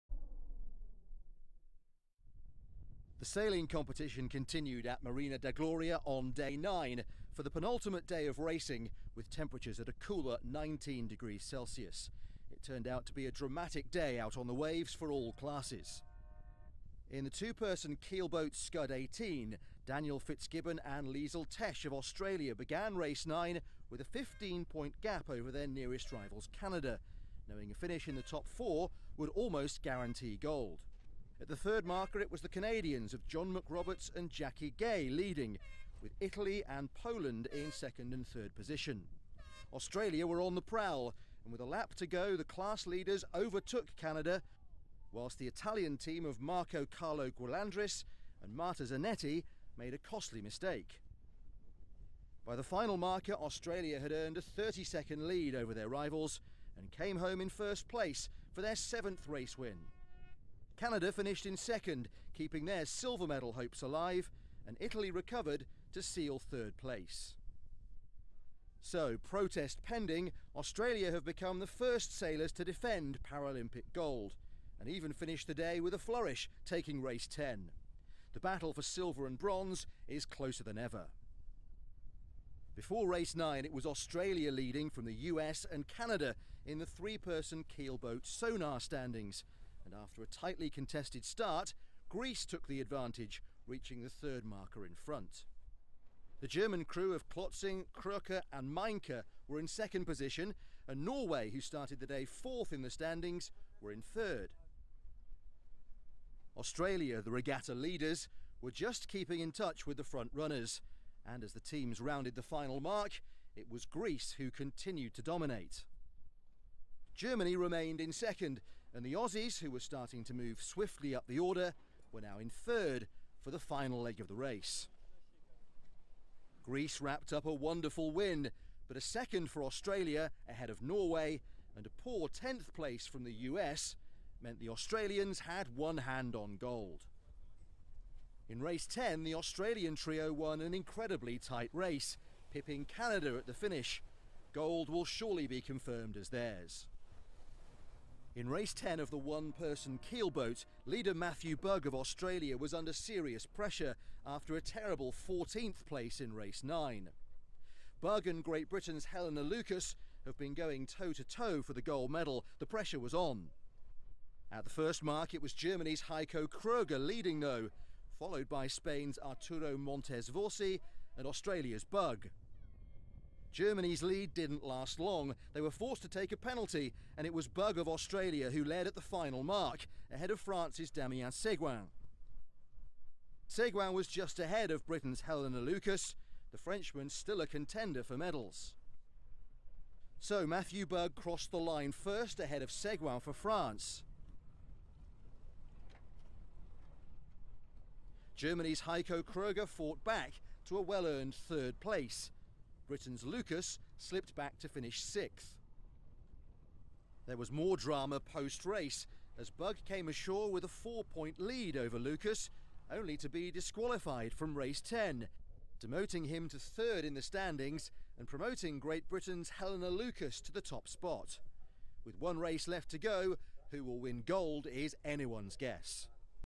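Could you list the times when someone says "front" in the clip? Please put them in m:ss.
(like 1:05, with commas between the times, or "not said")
1:34, 1:50.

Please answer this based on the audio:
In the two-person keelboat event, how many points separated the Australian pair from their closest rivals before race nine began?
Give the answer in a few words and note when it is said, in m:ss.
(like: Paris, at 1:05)
15, at 0:24.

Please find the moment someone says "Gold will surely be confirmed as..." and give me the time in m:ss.
2:24.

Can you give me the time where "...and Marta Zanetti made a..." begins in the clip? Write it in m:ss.
0:48.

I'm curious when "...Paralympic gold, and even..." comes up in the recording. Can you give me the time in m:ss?
1:13.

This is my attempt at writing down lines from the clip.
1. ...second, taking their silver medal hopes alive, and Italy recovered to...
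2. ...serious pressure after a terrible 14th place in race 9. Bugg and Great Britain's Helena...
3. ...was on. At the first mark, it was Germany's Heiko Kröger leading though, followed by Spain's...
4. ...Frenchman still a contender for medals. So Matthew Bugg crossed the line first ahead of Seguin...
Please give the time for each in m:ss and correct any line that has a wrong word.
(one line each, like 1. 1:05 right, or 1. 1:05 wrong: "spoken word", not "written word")
1. 1:01 wrong: "keeping", not "taking"
2. 2:32 right
3. 2:43 right
4. 3:06 right.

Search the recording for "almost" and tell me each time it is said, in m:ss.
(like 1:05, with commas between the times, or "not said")
0:29.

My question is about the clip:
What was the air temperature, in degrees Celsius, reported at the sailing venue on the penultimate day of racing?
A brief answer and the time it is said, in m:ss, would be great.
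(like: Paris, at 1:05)
19, at 0:10.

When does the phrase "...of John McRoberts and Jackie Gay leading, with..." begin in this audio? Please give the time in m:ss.
0:33.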